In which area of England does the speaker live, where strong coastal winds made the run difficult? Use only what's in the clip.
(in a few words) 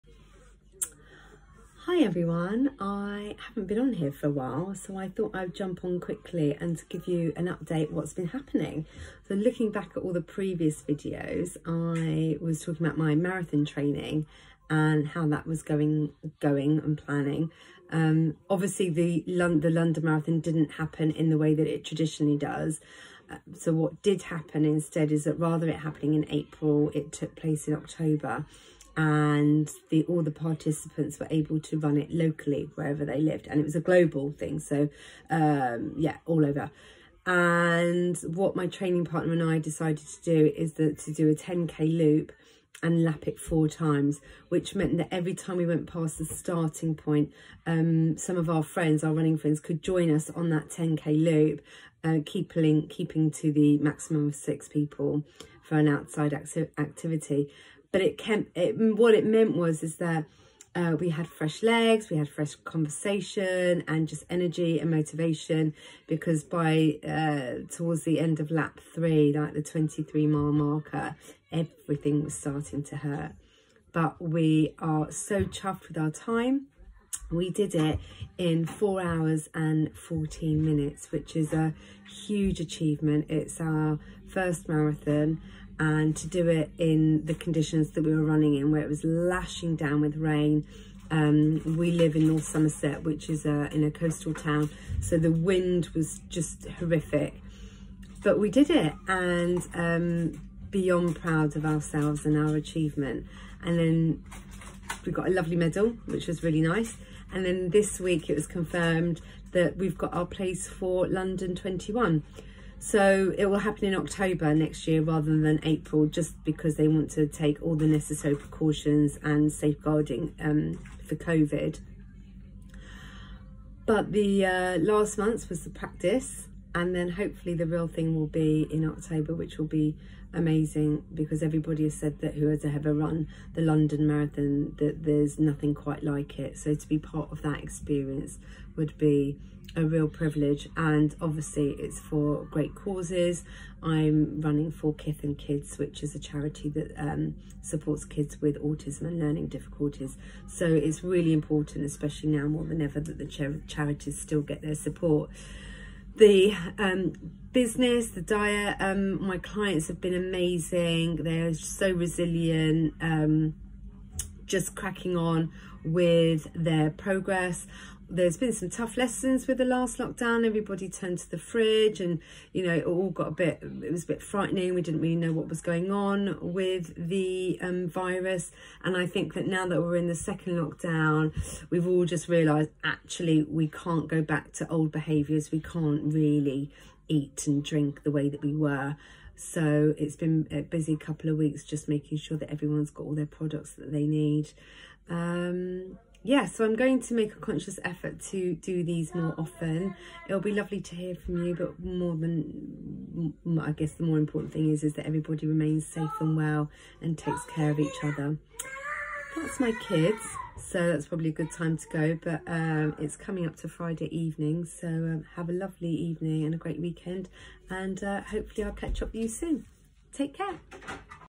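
North Somerset.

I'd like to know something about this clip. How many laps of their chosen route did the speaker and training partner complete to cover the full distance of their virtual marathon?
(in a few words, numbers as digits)
4.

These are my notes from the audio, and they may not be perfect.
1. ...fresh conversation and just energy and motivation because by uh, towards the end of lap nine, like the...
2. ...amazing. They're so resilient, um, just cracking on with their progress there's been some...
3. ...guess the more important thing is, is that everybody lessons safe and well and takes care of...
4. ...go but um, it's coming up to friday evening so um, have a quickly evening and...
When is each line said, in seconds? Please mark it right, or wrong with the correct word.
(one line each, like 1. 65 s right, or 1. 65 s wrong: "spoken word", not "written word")
1. 62 s wrong: "three", not "nine"
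2. 160 s right
3. 203 s wrong: "remains", not "lessons"
4. 211 s wrong: "lovely", not "quickly".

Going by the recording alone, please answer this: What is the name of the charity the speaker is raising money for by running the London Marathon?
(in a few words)
Kith and Kids.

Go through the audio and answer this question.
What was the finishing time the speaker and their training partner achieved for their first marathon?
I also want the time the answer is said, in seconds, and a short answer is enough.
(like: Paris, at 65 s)
4 hours 14 minutes, at 78 s.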